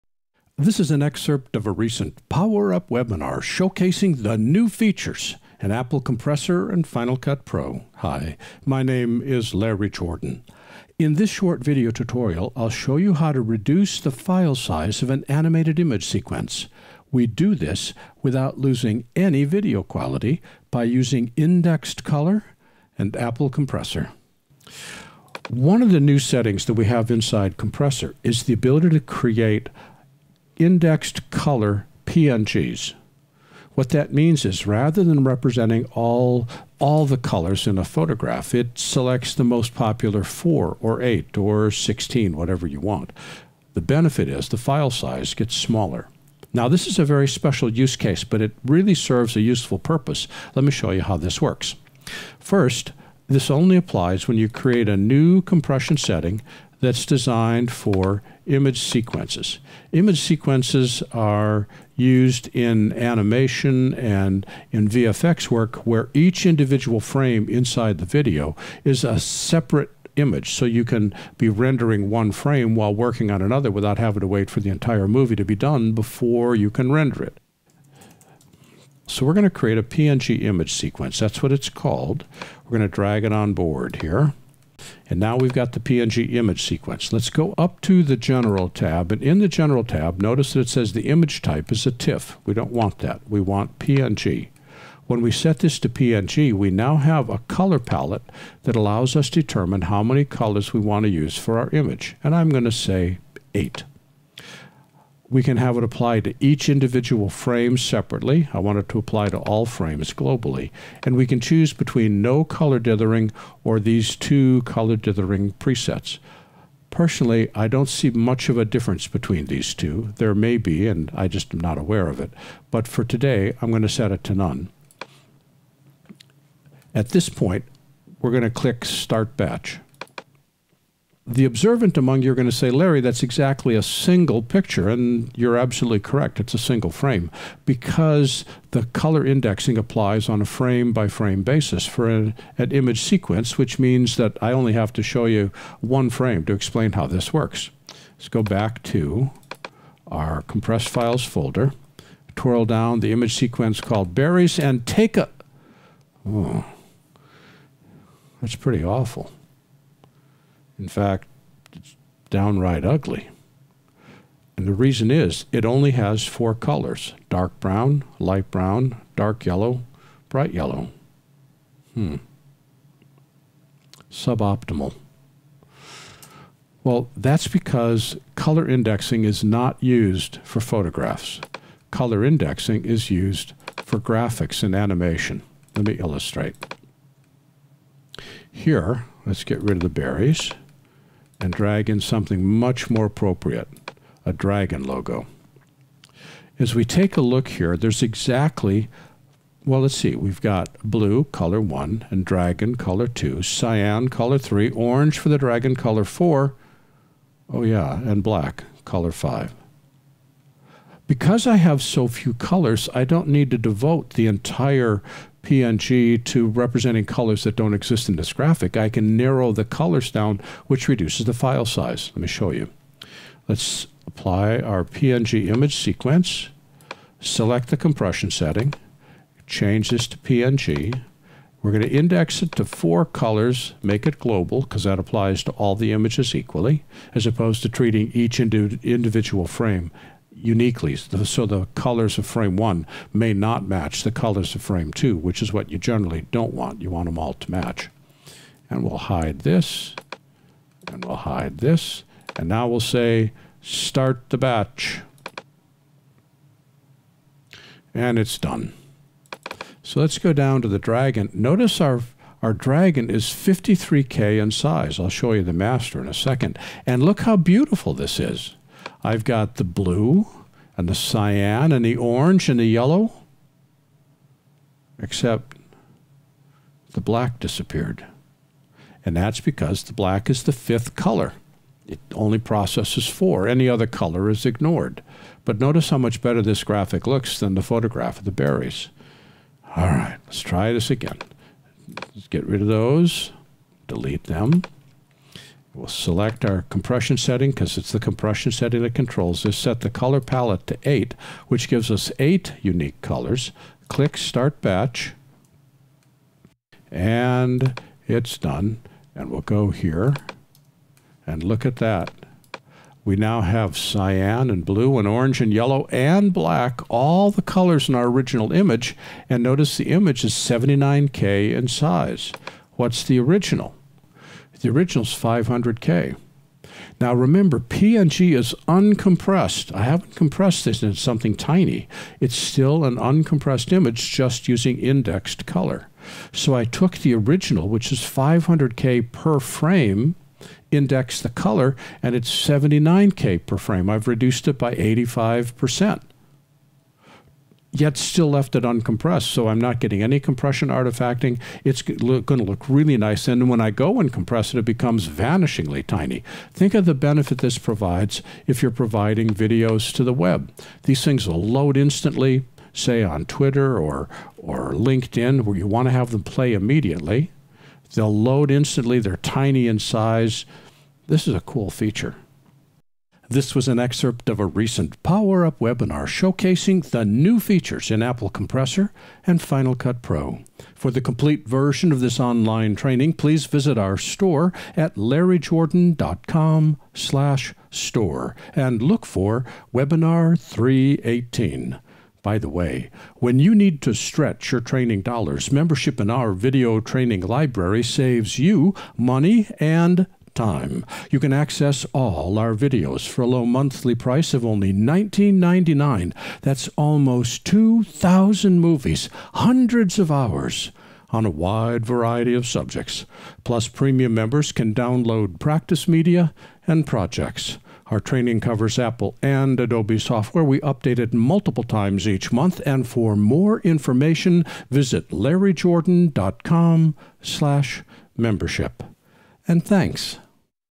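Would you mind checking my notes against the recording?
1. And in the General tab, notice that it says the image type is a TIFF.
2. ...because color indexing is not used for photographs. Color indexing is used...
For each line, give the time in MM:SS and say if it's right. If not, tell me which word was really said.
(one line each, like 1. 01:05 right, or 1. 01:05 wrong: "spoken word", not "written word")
1. 01:29 right
2. 02:57 right.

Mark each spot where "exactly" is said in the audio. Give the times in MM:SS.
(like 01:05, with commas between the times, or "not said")
02:13, 03:18.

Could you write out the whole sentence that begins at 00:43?
The benefit is the file size gets smaller.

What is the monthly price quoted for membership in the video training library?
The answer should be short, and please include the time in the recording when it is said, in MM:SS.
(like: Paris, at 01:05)
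$19.99, at 06:44.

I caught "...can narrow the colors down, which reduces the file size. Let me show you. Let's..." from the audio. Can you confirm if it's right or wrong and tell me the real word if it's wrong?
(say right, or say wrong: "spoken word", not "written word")
right.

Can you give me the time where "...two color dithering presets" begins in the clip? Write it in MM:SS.
01:54.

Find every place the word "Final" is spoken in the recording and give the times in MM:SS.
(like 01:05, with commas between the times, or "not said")
00:06, 06:19.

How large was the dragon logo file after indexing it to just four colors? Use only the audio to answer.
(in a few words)
53K.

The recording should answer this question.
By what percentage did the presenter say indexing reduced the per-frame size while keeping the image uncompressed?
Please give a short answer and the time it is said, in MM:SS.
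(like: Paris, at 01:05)
85%, at 05:44.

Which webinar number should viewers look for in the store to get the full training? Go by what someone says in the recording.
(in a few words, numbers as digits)
318.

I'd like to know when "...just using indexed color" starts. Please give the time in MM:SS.
05:34.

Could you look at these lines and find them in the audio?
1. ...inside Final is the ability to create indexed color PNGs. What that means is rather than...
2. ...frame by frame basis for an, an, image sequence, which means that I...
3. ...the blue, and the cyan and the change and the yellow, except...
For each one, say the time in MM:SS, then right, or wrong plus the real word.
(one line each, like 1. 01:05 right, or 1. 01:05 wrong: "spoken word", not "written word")
1. 00:27 wrong: "Compressor", not "Final"
2. 02:20 right
3. 04:29 wrong: "orange", not "change".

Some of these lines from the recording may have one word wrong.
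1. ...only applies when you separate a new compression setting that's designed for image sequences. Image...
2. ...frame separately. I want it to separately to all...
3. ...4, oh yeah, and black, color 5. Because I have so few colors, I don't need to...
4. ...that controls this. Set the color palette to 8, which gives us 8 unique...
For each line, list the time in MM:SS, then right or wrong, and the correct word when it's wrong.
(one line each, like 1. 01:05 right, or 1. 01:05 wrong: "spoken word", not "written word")
1. 00:53 wrong: "create", not "separate"
2. 01:47 wrong: "apply", not "separately"
3. 03:26 right
4. 04:58 right.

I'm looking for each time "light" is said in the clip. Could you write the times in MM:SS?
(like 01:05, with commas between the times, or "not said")
02:48.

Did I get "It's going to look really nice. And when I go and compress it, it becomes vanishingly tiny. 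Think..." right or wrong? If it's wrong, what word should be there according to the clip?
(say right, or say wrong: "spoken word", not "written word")
right.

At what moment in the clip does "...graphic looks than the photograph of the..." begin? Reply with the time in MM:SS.
04:46.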